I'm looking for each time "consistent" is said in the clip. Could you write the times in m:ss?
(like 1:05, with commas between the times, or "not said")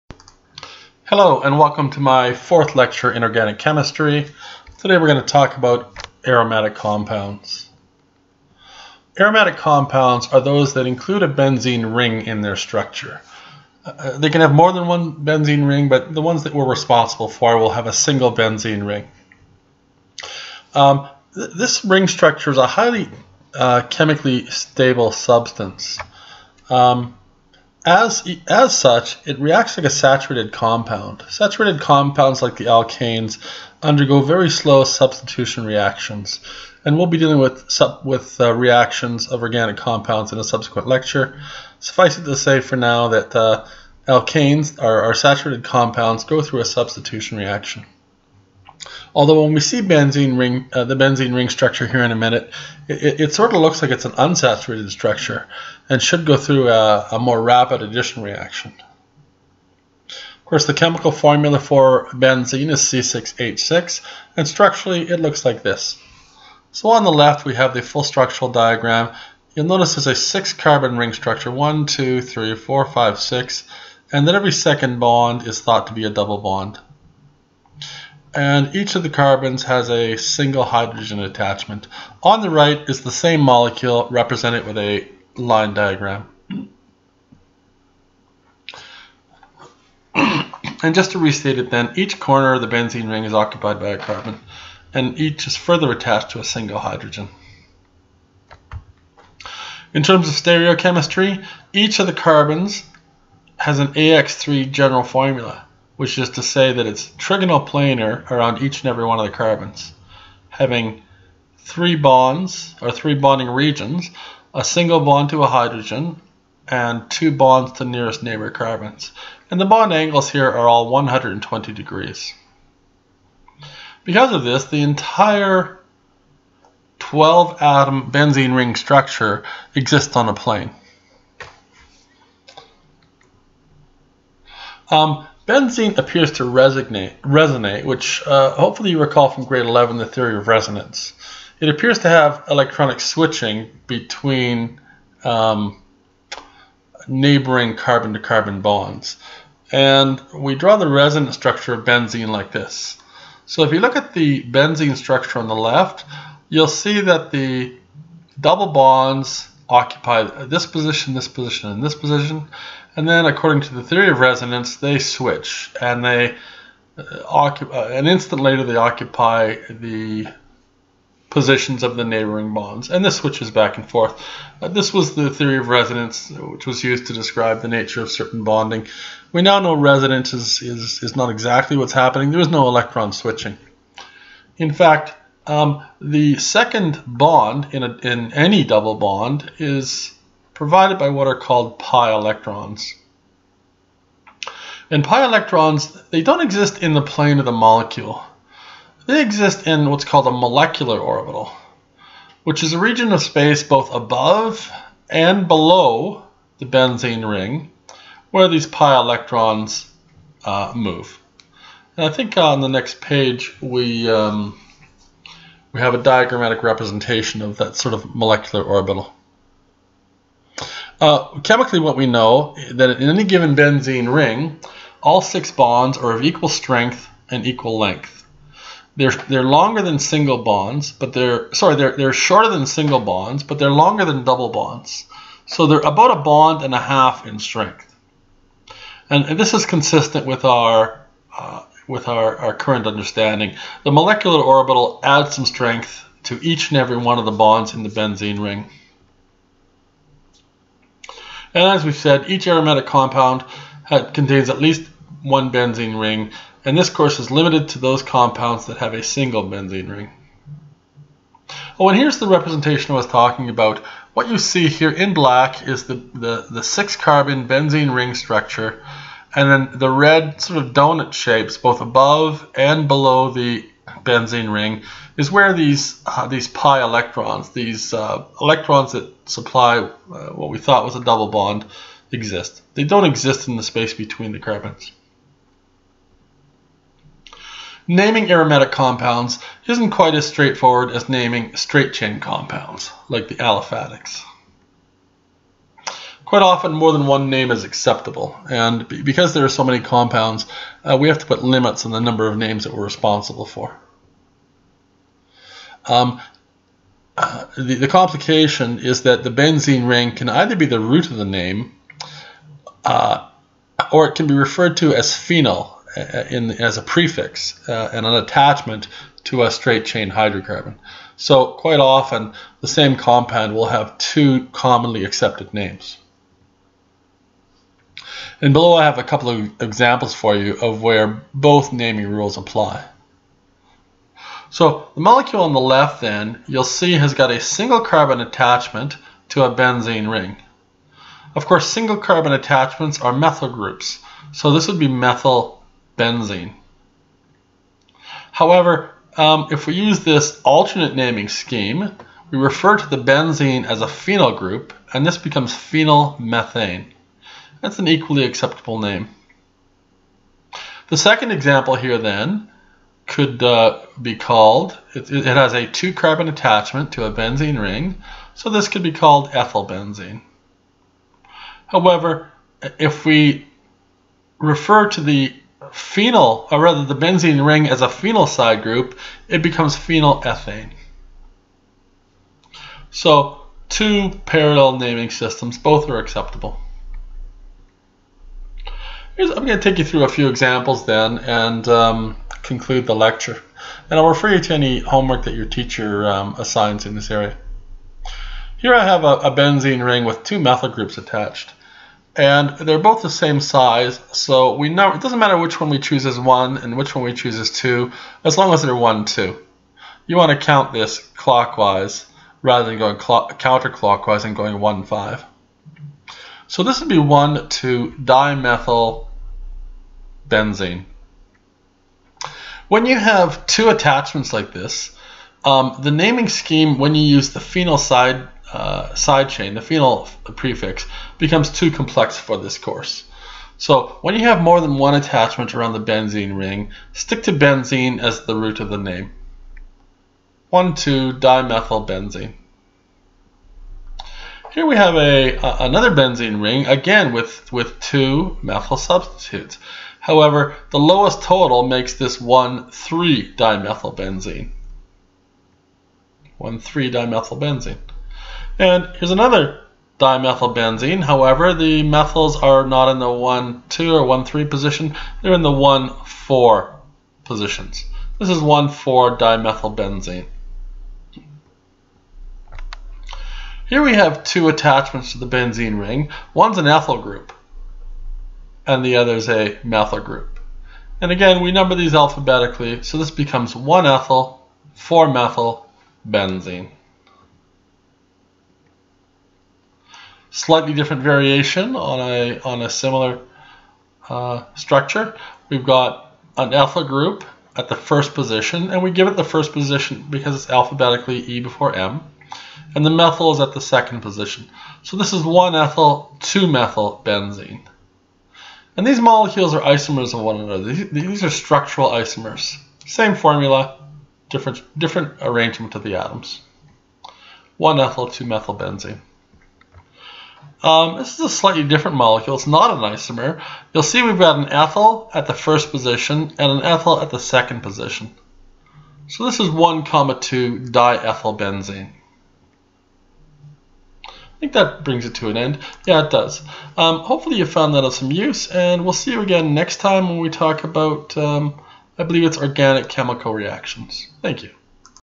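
3:59.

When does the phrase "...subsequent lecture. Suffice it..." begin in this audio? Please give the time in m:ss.
0:40.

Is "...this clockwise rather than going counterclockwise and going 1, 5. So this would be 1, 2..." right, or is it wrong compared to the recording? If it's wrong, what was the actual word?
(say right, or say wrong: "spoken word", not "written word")
right.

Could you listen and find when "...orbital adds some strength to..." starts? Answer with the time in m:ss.
4:04.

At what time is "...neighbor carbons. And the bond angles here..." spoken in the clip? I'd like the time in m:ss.
1:58.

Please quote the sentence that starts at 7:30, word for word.
However, the lowest total makes this 1,3-dimethylbenzene.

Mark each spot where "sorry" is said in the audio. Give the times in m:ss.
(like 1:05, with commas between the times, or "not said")
3:51.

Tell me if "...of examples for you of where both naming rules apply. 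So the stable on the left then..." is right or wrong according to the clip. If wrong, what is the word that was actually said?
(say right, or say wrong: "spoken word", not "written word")
wrong: "molecule", not "stable".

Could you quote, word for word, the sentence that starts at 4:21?
Oh, and here's the representation I was talking about.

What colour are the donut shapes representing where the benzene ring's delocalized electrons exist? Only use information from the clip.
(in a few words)
red.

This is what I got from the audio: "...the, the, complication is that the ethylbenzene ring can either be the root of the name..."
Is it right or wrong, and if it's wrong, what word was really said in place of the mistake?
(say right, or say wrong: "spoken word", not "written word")
wrong: "benzene", not "ethylbenzene".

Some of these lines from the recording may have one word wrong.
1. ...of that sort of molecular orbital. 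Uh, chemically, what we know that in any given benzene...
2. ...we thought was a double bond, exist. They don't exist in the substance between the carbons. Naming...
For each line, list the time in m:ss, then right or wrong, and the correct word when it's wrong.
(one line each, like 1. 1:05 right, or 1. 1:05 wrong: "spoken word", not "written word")
1. 3:37 right
2. 4:40 wrong: "space", not "substance".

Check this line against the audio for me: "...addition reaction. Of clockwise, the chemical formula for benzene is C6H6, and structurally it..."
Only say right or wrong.
wrong.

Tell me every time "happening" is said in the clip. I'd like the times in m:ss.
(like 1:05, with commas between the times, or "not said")
3:01.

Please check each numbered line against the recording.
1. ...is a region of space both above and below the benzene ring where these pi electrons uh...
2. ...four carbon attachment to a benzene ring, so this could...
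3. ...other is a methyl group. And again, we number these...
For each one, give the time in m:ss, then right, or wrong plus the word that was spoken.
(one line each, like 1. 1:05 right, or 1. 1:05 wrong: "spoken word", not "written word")
1. 3:22 right
2. 6:05 wrong: "two", not "four"
3. 7:58 right.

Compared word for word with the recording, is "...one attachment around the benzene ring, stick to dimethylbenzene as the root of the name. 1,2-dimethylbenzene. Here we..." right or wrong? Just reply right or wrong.
wrong.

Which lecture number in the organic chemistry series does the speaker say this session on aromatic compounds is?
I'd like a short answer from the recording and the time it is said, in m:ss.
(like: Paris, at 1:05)
fourth, at 0:02.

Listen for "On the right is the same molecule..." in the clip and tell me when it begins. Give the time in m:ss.
1:22.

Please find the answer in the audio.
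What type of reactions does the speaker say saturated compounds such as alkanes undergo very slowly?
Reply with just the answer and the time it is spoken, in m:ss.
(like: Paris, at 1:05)
substitution reactions, at 0:34.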